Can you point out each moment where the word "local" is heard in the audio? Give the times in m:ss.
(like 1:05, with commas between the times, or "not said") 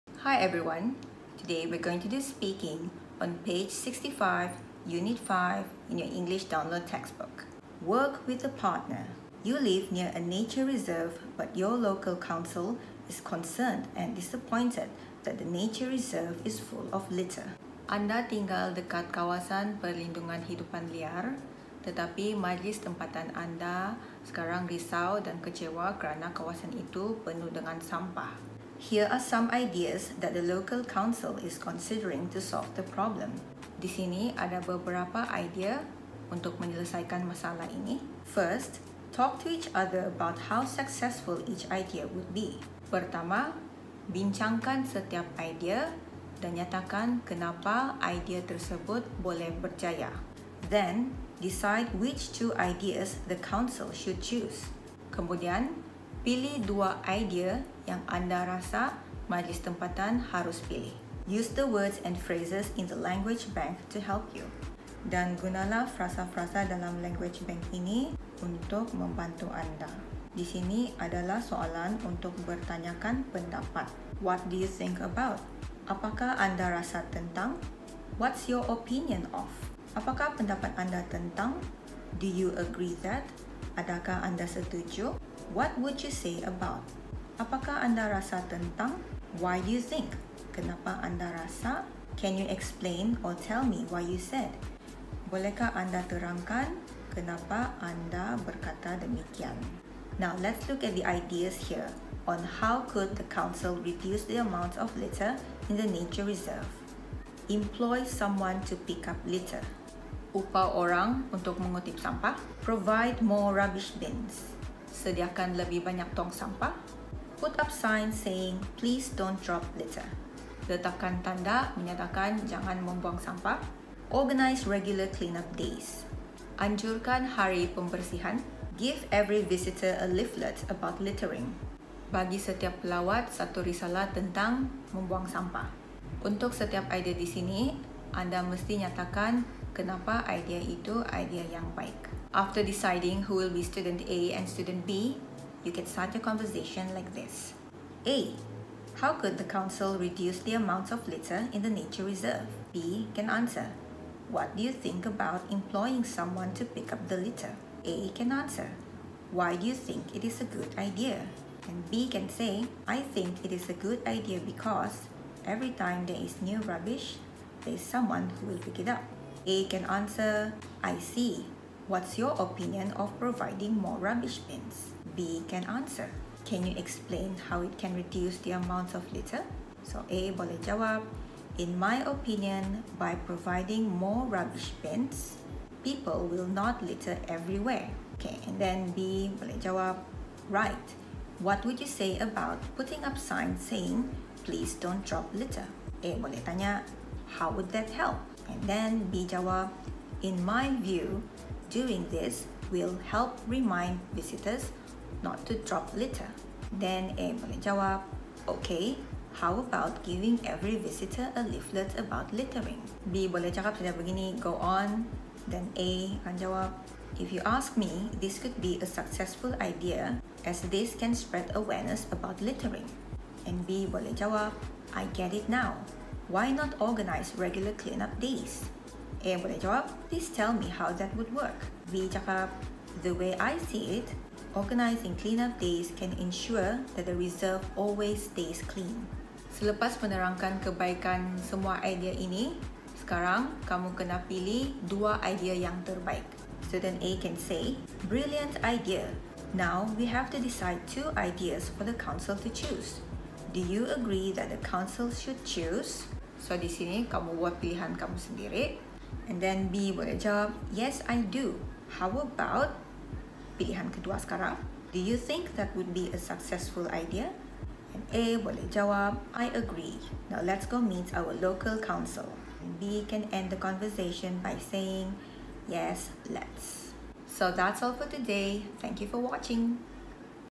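0:11, 0:30, 4:31.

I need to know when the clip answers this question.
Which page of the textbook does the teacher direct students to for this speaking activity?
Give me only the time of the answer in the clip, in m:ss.
0:03.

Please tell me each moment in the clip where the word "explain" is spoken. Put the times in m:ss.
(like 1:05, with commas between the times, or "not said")
1:32, 2:56.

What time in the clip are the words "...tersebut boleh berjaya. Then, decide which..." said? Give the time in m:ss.
0:48.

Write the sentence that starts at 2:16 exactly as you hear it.
Untuk setiap idea di sini, anda mesti nyatakan kenapa idea itu idea yang baik.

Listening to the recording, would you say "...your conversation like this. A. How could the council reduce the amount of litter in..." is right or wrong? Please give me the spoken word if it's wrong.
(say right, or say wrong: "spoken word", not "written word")
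right.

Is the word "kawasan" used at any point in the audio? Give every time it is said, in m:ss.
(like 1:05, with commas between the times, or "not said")
0:19, 0:26.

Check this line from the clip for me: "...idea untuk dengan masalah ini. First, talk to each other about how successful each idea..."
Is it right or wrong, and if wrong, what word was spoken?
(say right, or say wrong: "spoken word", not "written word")
wrong: "menyelesaikan", not "dengan".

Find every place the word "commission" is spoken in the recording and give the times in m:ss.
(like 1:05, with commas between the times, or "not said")
not said.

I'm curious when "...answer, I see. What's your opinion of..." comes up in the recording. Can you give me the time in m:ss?
2:49.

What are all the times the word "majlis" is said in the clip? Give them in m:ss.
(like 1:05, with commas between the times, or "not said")
0:22, 0:59.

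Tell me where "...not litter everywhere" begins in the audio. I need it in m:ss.
3:06.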